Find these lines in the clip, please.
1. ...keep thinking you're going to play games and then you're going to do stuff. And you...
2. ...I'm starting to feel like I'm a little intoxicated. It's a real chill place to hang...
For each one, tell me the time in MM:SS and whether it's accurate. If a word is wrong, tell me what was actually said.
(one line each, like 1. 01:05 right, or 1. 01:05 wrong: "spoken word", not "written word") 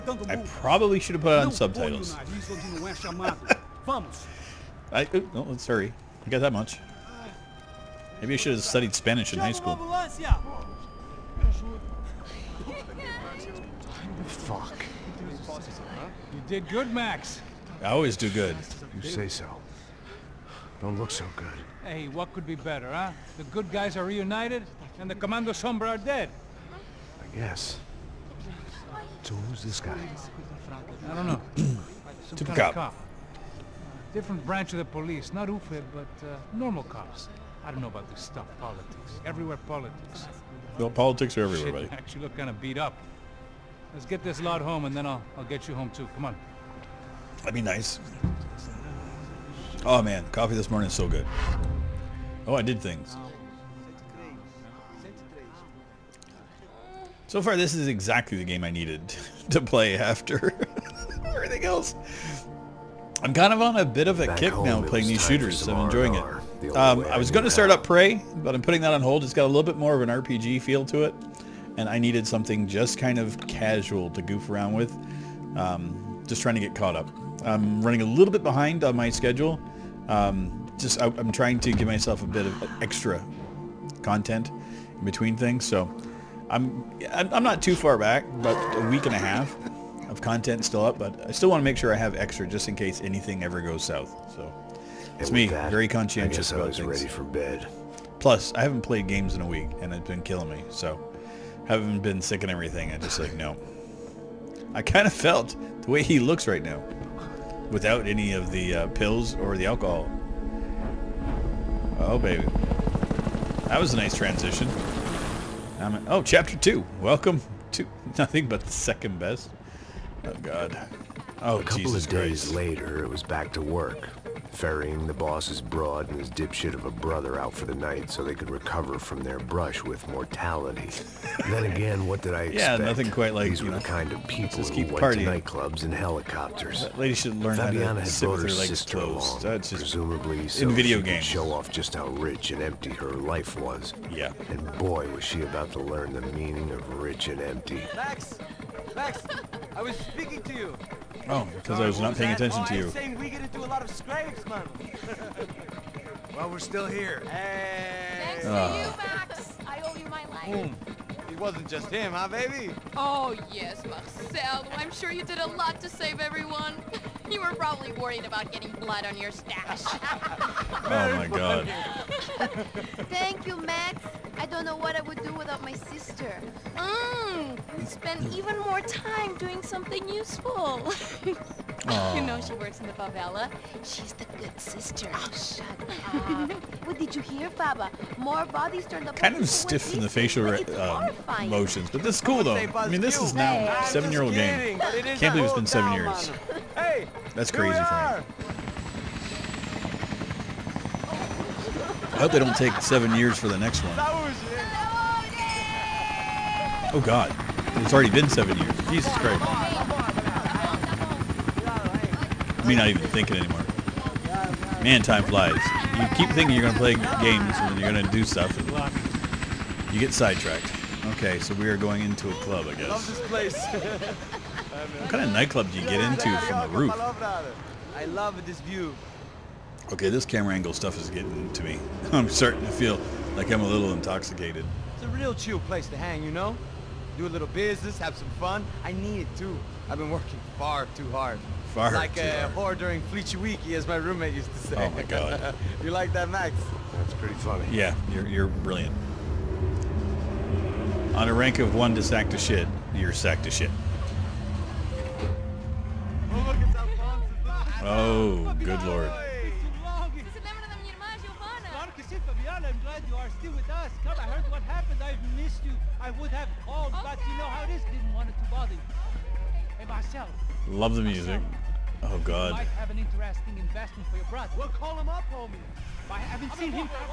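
1. 03:36 right
2. 03:52 right.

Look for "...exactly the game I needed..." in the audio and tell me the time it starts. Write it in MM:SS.
00:57.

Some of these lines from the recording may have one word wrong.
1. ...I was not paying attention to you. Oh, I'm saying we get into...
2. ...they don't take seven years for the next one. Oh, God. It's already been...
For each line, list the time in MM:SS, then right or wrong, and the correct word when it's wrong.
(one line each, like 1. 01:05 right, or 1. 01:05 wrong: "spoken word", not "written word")
1. 02:31 right
2. 03:22 right.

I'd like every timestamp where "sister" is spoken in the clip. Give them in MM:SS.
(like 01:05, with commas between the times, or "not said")
02:18, 02:55, 03:04.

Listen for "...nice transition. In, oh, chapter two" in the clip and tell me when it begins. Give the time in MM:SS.
01:53.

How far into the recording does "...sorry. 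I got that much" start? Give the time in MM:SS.
00:05.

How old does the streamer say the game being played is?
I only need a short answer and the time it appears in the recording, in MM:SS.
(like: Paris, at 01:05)
7 years, at 03:13.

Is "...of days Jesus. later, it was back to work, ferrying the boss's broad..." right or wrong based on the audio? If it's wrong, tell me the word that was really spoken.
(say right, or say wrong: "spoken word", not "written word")
wrong: "Christ", not "Jesus".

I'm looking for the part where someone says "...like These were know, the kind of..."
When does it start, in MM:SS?
02:13.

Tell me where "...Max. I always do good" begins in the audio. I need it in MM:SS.
00:16.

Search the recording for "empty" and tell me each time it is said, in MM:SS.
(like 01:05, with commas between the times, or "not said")
02:22, 02:27.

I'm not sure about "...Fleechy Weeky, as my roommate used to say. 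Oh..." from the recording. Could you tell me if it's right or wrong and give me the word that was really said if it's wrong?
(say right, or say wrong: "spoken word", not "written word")
right.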